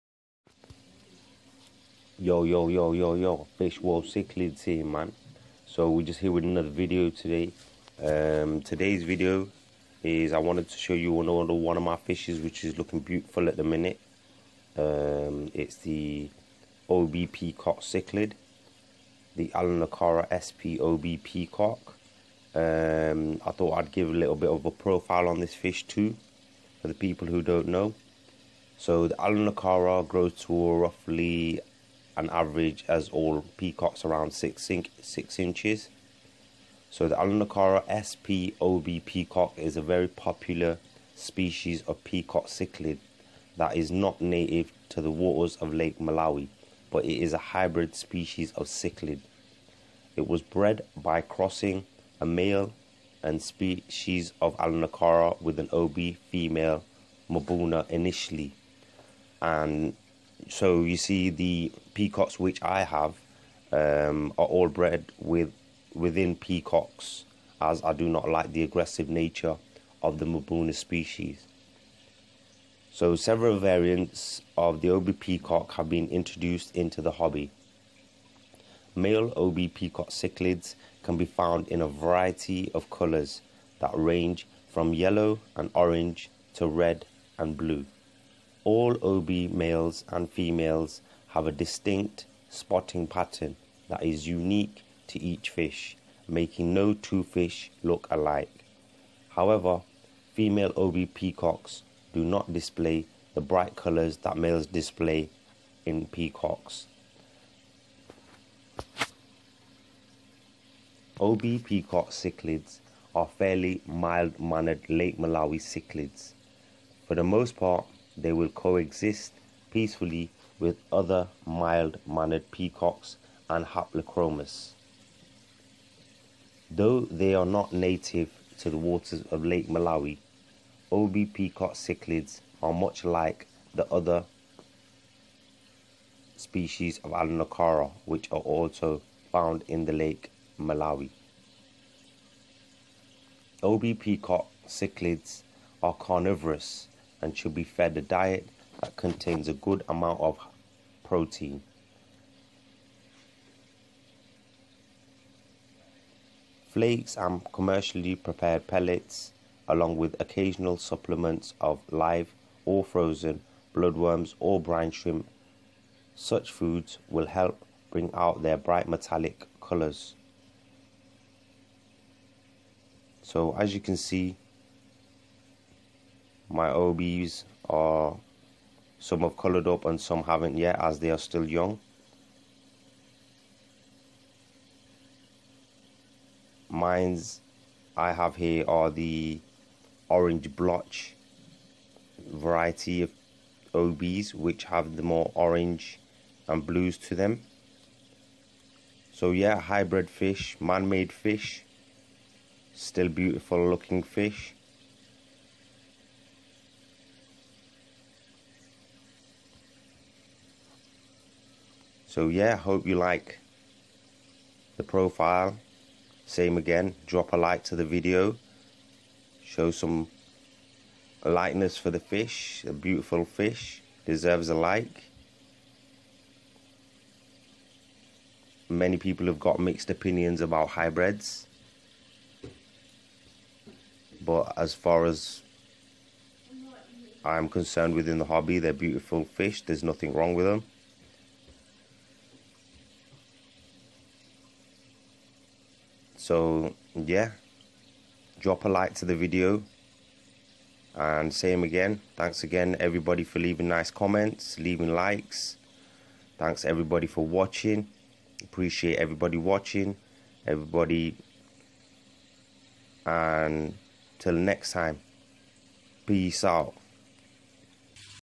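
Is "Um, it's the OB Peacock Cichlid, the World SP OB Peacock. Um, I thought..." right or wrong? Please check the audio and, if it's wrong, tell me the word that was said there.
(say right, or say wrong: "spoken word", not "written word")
wrong: "Aulonocara", not "World".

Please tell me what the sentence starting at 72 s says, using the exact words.
So several variants of the OB peacock have been introduced into the hobby.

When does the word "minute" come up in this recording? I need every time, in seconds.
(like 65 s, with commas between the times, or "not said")
13 s.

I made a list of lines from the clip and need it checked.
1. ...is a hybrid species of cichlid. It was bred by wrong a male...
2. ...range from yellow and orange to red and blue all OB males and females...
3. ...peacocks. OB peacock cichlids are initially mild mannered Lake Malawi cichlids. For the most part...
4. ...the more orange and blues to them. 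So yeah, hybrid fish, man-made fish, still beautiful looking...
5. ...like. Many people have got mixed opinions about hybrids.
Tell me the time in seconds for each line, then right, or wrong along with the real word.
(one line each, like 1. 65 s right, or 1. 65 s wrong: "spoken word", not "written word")
1. 47 s wrong: "crossing", not "wrong"
2. 83 s right
3. 106 s wrong: "fairly", not "initially"
4. 194 s right
5. 224 s right.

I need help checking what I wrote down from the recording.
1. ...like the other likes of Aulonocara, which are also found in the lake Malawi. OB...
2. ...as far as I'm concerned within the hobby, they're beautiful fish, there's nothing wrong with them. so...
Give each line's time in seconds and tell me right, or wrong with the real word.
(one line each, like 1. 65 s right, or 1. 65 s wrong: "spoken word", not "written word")
1. 133 s wrong: "species", not "likes"
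2. 234 s right.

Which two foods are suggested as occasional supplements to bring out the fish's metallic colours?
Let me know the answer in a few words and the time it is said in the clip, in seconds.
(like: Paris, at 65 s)
Bloodworms or brine shrimp, at 163 s.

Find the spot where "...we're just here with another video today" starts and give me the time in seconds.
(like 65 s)
5 s.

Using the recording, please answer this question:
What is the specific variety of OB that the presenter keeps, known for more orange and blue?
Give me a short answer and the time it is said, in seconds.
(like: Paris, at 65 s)
Orange blotch, at 190 s.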